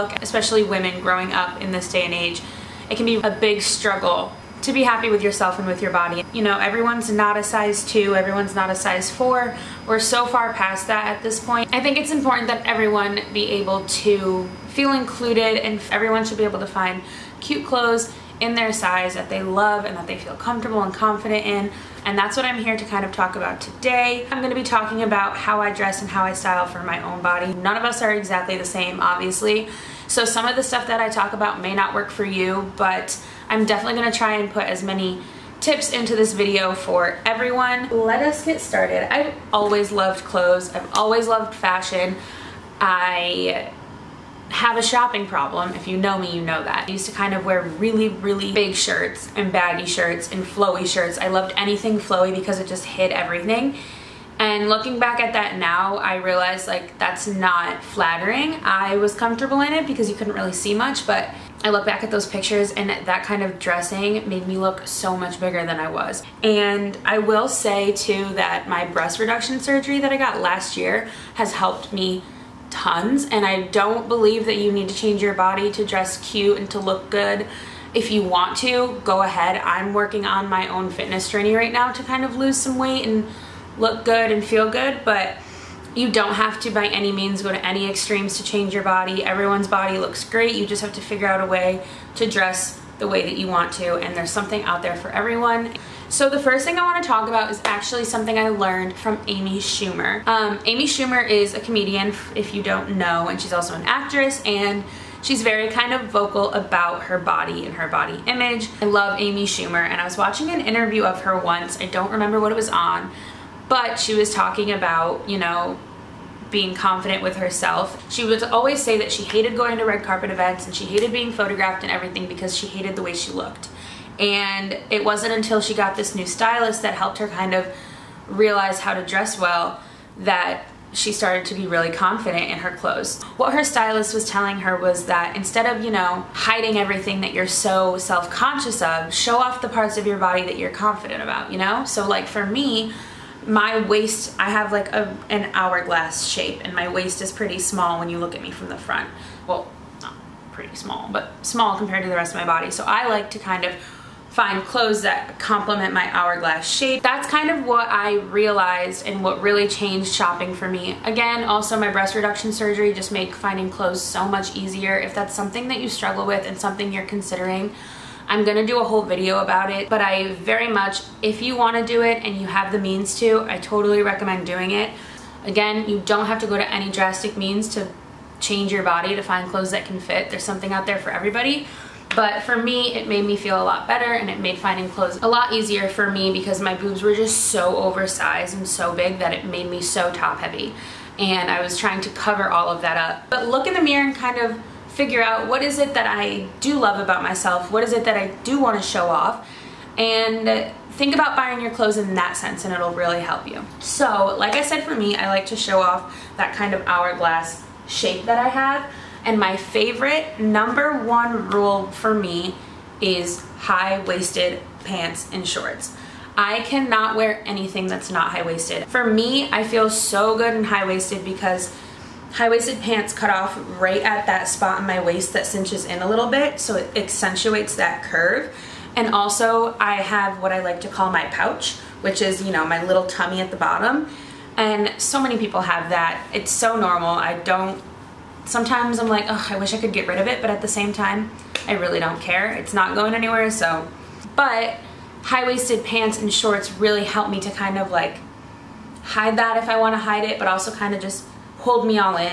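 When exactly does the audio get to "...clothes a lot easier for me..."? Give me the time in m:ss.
3:04.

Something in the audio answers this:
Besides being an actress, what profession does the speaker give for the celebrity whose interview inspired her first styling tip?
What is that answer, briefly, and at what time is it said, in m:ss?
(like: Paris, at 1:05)
comedian, at 1:41.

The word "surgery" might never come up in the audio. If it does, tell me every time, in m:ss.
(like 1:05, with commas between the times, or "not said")
1:09, 2:42.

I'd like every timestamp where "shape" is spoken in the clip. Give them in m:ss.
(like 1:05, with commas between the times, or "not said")
2:26, 2:36, 3:27.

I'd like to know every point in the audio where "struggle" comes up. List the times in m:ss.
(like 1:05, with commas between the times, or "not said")
0:03, 2:45.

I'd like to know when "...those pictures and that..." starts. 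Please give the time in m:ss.
1:02.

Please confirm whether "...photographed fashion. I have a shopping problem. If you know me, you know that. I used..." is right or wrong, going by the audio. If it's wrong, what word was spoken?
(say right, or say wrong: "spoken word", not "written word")
wrong: "loved", not "photographed".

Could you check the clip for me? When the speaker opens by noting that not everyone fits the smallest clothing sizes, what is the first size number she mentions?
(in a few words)
size 2.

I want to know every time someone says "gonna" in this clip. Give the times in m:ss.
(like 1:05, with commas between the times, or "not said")
0:24, 0:34, 2:48.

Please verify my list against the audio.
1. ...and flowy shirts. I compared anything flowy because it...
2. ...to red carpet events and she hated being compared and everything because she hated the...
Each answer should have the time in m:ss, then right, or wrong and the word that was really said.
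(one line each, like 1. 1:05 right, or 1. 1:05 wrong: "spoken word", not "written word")
1. 0:50 wrong: "loved", not "compared"
2. 1:59 wrong: "photographed", not "compared".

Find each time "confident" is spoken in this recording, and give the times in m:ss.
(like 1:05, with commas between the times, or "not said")
0:20, 1:56, 2:11, 2:20.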